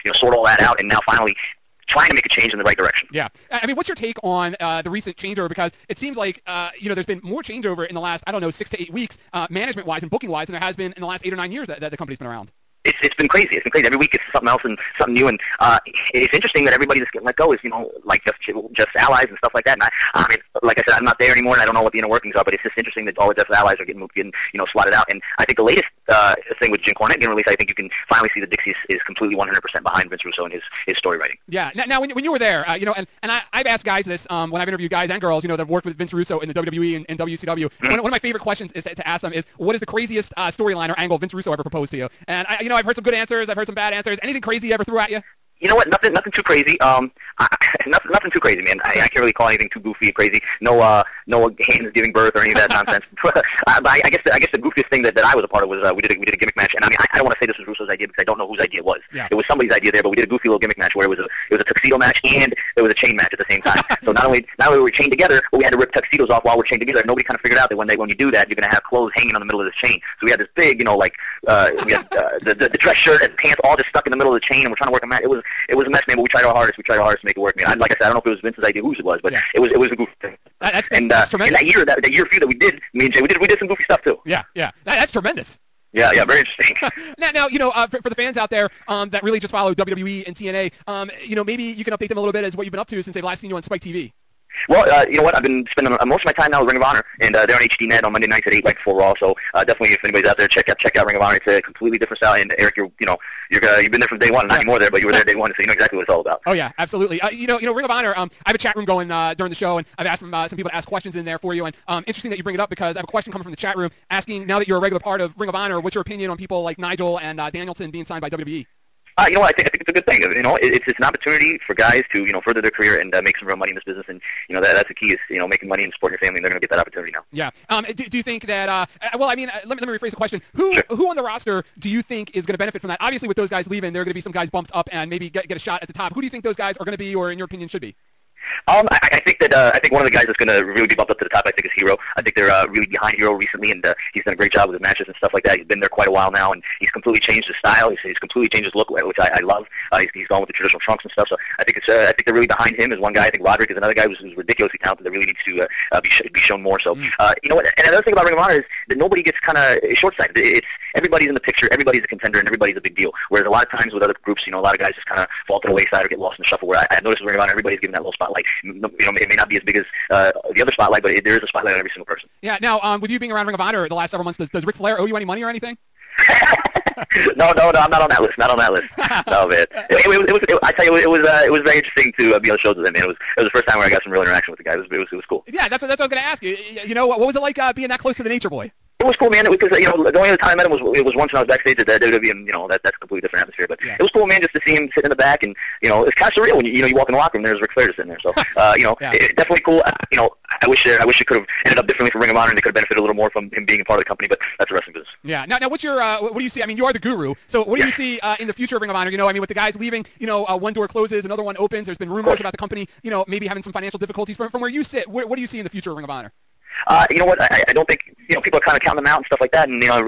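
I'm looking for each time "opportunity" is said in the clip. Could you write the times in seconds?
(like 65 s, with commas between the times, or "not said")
121 s, 126 s.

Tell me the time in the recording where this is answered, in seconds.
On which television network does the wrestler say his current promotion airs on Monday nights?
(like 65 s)
97 s.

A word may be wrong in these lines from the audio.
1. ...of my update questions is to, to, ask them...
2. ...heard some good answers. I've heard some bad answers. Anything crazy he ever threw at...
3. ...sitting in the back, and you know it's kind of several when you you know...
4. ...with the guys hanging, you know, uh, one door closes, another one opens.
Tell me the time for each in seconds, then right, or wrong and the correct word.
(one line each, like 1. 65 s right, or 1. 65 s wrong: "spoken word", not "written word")
1. 38 s wrong: "favorite", not "update"
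2. 42 s right
3. 194 s wrong: "surreal", not "several"
4. 209 s wrong: "leaving", not "hanging".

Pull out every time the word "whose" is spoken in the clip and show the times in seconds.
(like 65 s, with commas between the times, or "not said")
58 s, 78 s.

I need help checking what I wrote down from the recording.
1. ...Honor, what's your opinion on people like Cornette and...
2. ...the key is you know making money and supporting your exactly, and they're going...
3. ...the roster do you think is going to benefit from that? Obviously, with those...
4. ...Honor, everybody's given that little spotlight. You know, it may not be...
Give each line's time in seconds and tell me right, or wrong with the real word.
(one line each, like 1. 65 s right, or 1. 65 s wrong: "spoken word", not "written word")
1. 115 s wrong: "Nigel", not "Cornette"
2. 124 s wrong: "family", not "exactly"
3. 131 s right
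4. 167 s right.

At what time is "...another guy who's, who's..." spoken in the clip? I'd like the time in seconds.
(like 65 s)
153 s.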